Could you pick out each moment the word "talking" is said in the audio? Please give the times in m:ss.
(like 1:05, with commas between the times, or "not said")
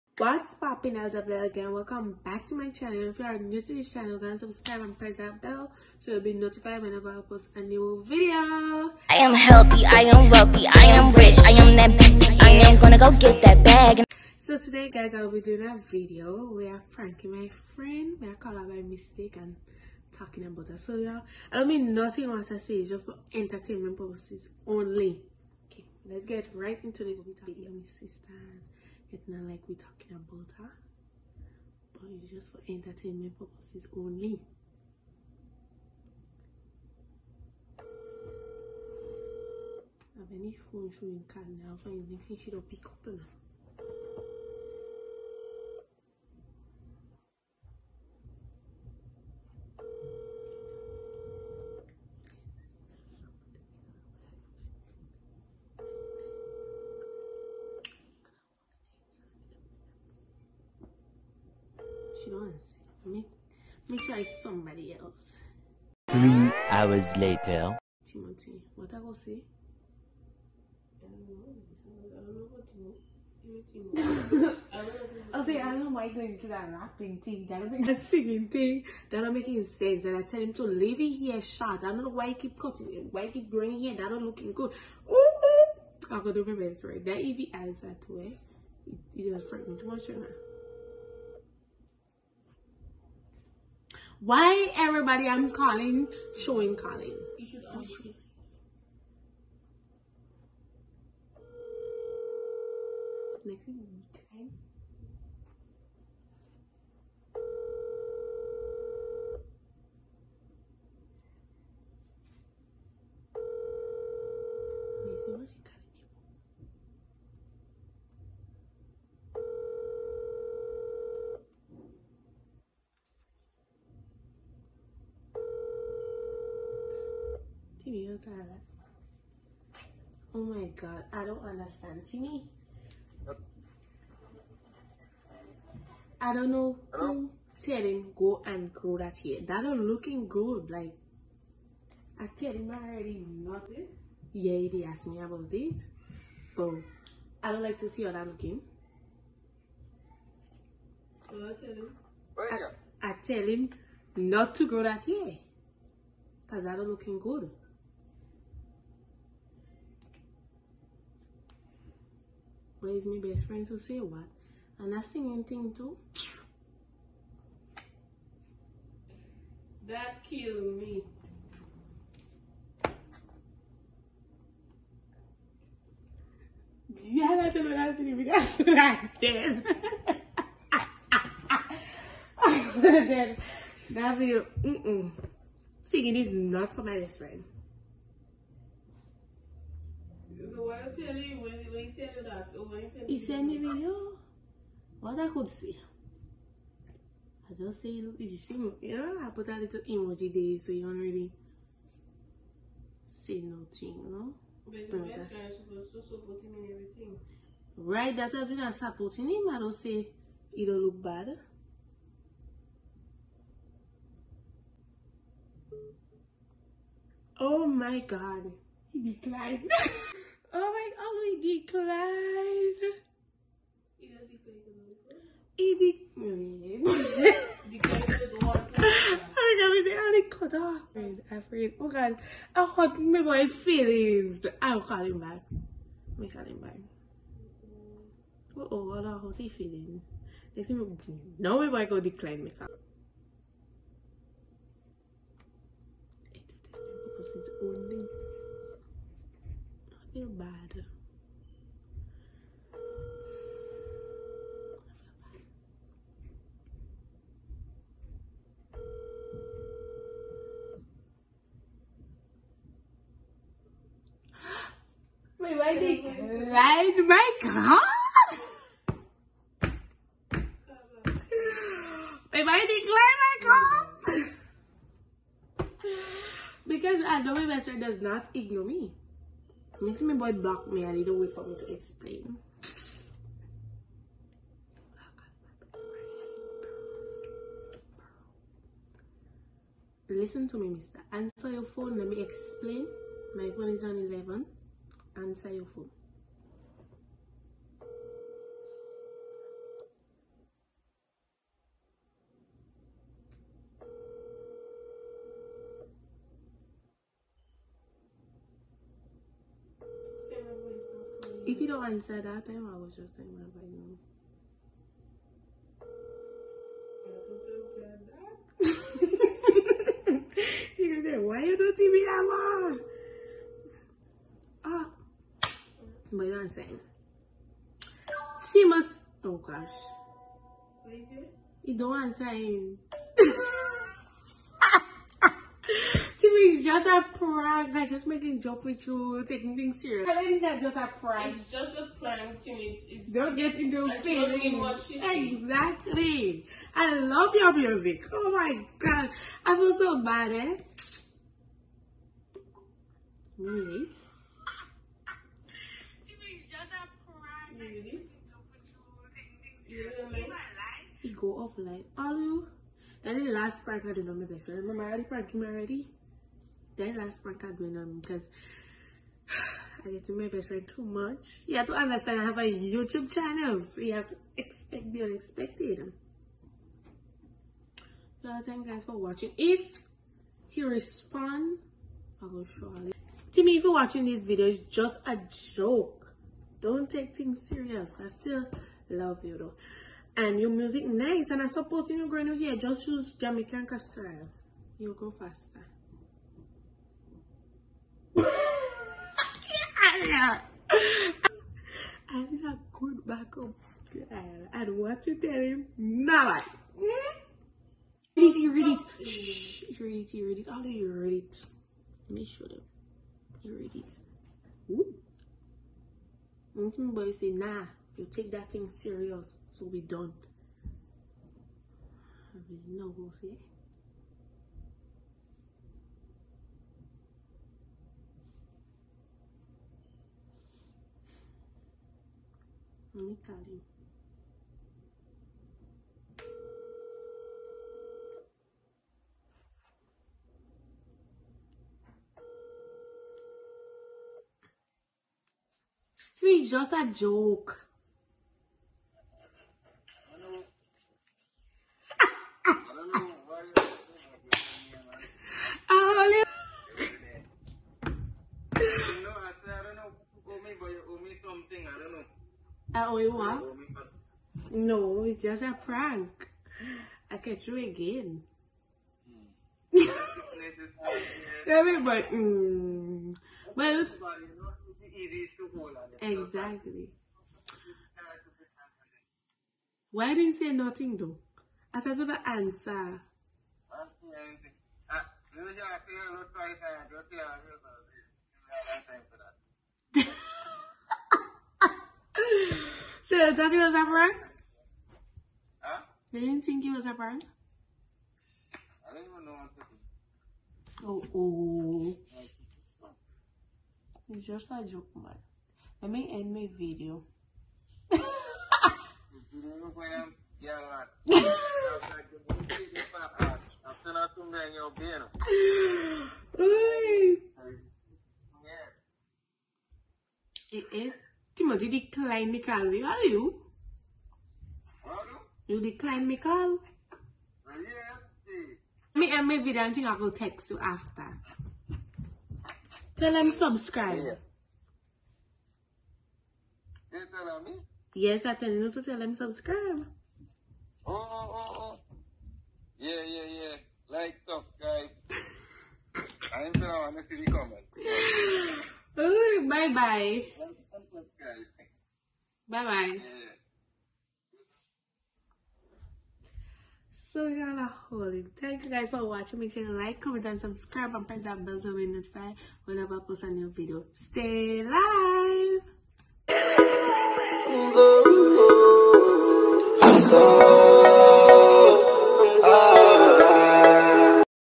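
0:20, 0:29.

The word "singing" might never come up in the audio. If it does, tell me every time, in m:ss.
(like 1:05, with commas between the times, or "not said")
1:17, 2:45, 3:05.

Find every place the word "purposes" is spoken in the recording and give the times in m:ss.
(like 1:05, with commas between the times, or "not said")
0:23, 0:33.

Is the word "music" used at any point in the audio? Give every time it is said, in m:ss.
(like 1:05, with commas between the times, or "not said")
5:47, 6:30.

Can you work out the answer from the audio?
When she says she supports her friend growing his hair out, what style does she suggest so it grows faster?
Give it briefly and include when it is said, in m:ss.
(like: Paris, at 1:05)
Jamaican style, at 6:33.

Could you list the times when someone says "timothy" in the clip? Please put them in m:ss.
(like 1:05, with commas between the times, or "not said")
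1:08, 1:13, 8:41.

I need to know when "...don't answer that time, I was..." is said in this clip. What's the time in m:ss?
5:11.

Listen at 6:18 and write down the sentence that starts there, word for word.
So thank you guys for watching.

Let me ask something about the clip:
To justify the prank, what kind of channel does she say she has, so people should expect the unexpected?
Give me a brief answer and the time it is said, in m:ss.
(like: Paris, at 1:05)
YouTube channel, at 6:12.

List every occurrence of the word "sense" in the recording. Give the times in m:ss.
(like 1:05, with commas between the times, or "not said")
1:19.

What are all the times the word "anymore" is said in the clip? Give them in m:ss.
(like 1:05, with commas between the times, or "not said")
not said.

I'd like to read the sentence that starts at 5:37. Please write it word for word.
I'm just making joke with you, taking things serious.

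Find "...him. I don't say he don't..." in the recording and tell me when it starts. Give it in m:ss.
3:29.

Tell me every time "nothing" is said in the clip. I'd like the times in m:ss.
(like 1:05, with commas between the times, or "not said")
0:21, 3:23, 8:00.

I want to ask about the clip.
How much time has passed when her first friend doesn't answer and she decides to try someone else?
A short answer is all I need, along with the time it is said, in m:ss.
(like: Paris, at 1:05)
3 hours, at 1:06.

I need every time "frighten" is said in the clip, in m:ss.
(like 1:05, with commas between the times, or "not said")
1:29.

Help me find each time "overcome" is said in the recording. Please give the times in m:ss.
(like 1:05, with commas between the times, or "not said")
not said.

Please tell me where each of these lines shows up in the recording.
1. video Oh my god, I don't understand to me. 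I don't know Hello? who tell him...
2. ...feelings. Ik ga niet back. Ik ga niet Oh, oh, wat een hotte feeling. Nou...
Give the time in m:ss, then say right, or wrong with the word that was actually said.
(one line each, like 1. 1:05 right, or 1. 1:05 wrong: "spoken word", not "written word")
1. 2:07 right
2. 3:53 right.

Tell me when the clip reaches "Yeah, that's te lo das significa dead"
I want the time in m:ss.
2:57.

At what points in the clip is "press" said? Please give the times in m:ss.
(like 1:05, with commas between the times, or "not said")
0:04, 9:21.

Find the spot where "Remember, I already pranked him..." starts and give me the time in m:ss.
6:04.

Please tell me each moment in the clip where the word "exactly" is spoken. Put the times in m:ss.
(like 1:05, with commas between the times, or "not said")
5:44, 7:56.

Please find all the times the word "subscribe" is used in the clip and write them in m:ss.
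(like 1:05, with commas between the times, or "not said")
0:04, 8:53, 8:59, 9:04, 9:20.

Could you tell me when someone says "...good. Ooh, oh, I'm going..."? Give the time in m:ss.
1:24.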